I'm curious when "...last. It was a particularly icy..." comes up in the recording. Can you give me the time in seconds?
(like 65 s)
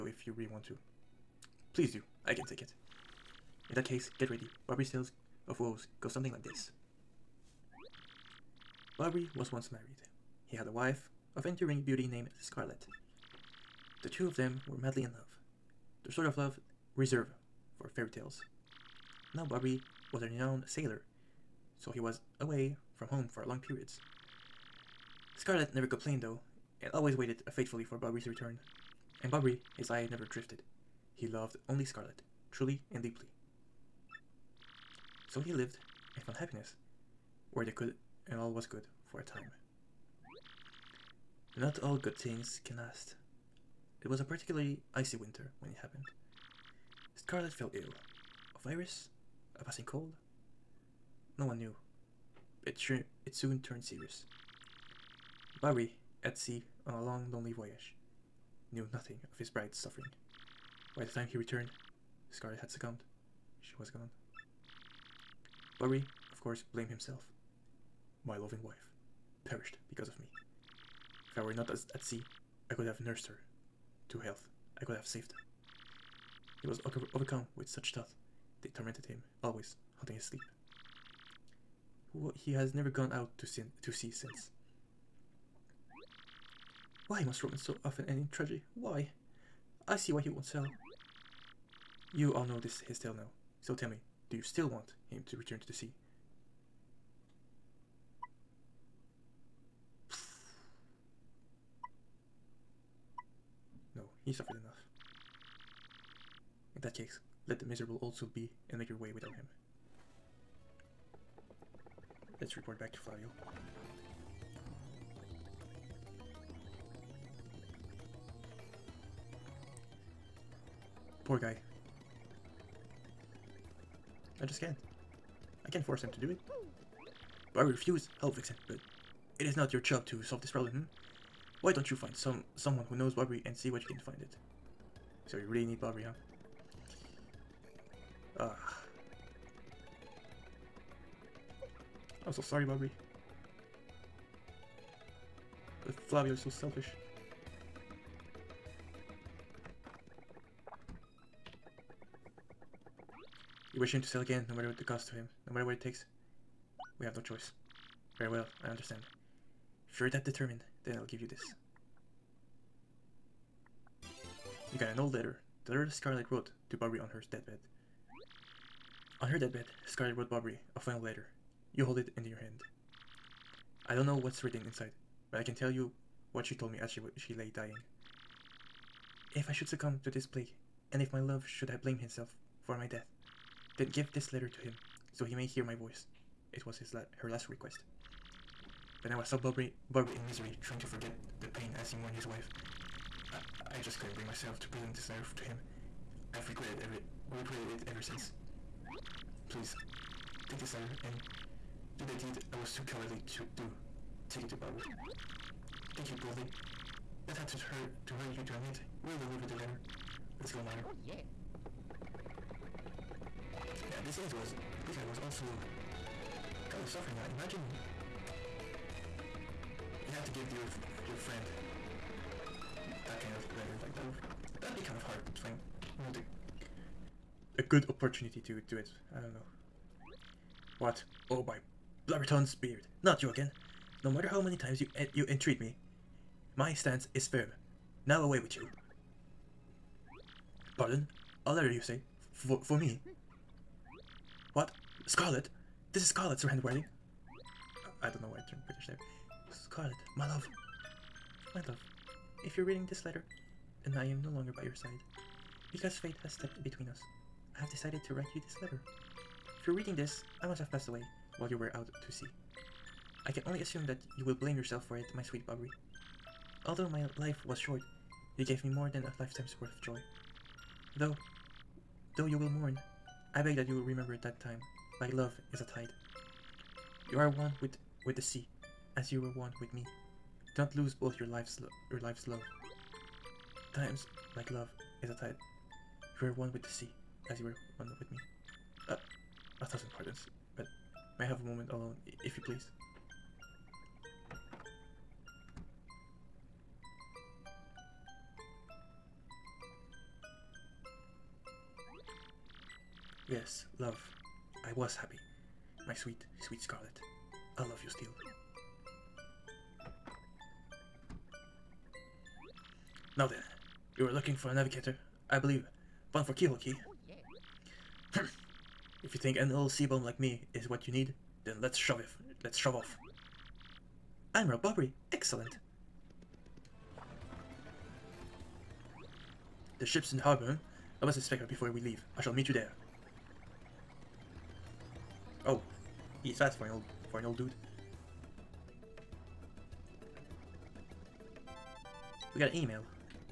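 42 s.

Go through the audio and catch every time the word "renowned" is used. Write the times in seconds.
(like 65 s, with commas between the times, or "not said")
20 s.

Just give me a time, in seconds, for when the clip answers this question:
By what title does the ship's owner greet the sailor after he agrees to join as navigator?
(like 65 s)
324 s.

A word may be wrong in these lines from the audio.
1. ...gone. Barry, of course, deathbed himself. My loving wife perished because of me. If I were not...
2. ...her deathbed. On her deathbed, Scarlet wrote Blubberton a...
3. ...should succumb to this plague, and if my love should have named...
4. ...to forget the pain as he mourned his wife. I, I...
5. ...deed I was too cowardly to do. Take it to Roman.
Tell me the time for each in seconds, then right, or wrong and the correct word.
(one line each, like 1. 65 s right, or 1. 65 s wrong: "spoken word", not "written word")
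1. 63 s wrong: "blamed", not "deathbed"
2. 167 s wrong: "Bobbery", not "Blubberton"
3. 179 s wrong: "blamed", not "named"
4. 190 s right
5. 202 s wrong: "Baru", not "Roman".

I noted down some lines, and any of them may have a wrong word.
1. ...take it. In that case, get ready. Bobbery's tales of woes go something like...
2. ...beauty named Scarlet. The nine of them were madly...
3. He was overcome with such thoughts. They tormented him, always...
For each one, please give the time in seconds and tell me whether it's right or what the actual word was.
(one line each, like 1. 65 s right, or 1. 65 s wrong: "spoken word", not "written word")
1. 2 s right
2. 11 s wrong: "two", not "nine"
3. 76 s right.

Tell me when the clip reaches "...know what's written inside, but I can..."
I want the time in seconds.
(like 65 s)
174 s.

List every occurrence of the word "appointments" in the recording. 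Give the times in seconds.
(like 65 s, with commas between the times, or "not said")
not said.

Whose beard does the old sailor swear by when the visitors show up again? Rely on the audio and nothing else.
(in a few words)
Blubberton's.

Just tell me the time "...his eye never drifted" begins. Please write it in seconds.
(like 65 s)
29 s.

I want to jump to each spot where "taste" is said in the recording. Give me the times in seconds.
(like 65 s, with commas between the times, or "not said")
not said.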